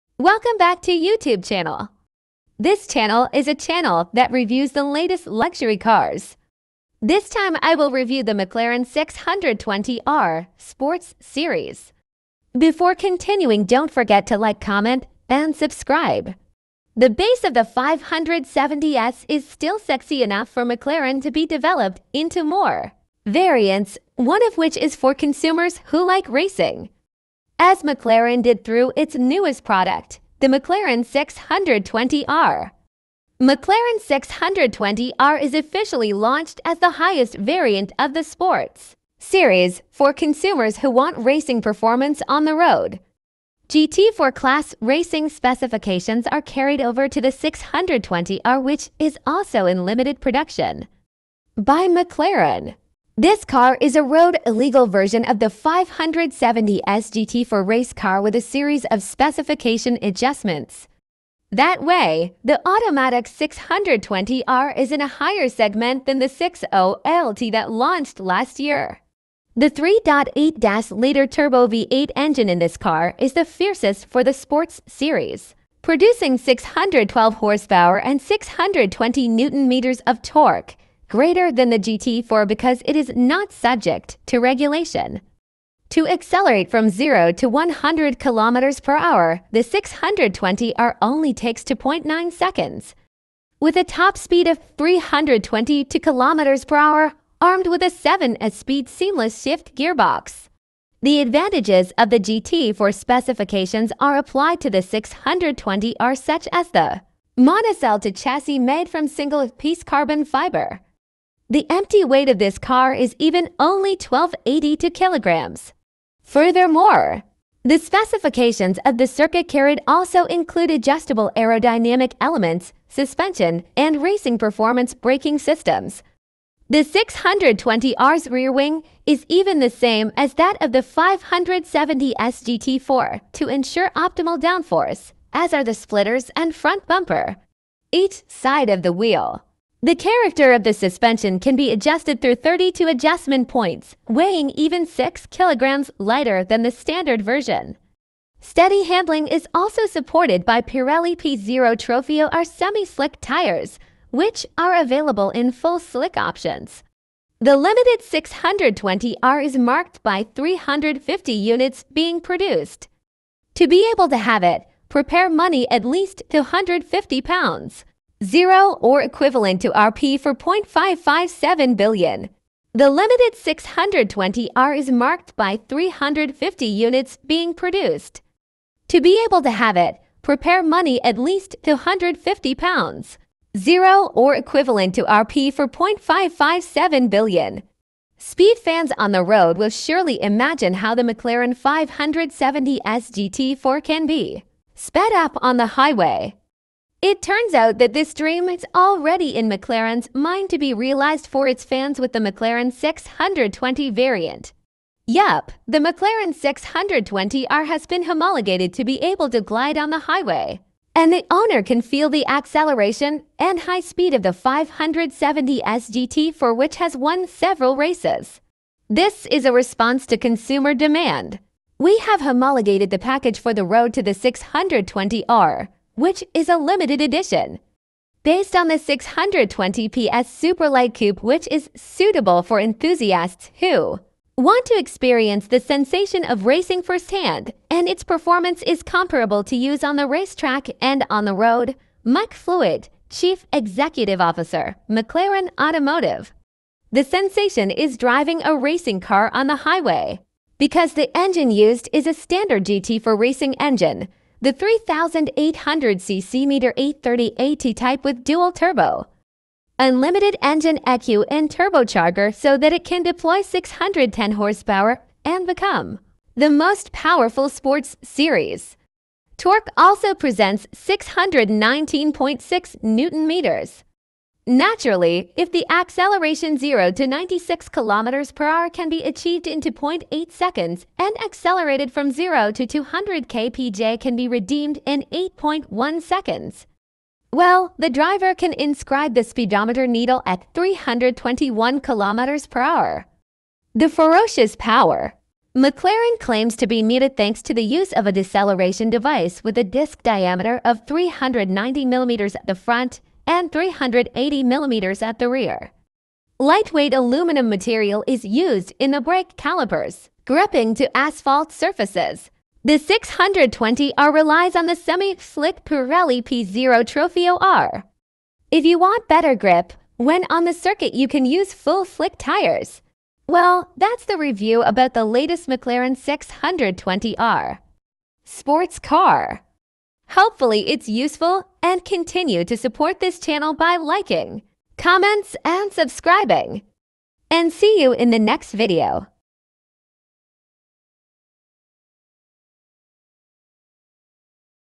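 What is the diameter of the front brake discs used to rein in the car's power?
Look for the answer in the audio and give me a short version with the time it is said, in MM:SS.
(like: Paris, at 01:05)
390 millimeters, at 05:00.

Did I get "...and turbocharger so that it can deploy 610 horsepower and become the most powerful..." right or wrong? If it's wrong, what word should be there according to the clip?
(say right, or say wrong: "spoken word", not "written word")
right.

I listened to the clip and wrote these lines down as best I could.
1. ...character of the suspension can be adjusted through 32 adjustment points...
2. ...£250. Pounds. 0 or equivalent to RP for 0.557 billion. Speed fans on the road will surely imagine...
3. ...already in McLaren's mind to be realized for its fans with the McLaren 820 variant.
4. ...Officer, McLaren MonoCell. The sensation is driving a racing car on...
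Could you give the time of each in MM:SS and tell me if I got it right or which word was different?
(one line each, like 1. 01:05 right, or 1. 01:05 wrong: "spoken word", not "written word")
1. 02:19 right
2. 03:01 right
3. 03:18 wrong: "620", not "820"
4. 04:04 wrong: "Automotive", not "MonoCell".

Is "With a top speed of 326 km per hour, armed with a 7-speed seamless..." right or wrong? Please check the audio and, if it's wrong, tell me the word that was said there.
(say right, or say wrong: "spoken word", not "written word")
wrong: "322", not "326".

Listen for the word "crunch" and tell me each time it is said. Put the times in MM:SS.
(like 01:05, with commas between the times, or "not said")
not said.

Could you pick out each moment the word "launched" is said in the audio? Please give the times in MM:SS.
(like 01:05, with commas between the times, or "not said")
00:36, 01:07.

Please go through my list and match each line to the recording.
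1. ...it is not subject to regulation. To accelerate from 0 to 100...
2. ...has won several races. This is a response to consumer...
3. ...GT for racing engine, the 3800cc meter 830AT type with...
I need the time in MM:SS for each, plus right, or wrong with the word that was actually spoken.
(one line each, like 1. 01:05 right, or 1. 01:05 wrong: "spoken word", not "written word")
1. 01:22 right
2. 03:36 right
3. 04:12 right.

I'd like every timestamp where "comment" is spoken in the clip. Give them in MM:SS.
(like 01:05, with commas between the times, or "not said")
00:14, 05:34.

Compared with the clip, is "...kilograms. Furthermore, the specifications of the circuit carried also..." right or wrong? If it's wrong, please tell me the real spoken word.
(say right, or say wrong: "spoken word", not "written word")
right.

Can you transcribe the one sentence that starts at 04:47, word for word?
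Well, the driver can inscribe the speedometer needle at 321 kilometers per hour.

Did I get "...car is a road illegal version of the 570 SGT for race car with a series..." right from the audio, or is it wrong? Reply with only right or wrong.
right.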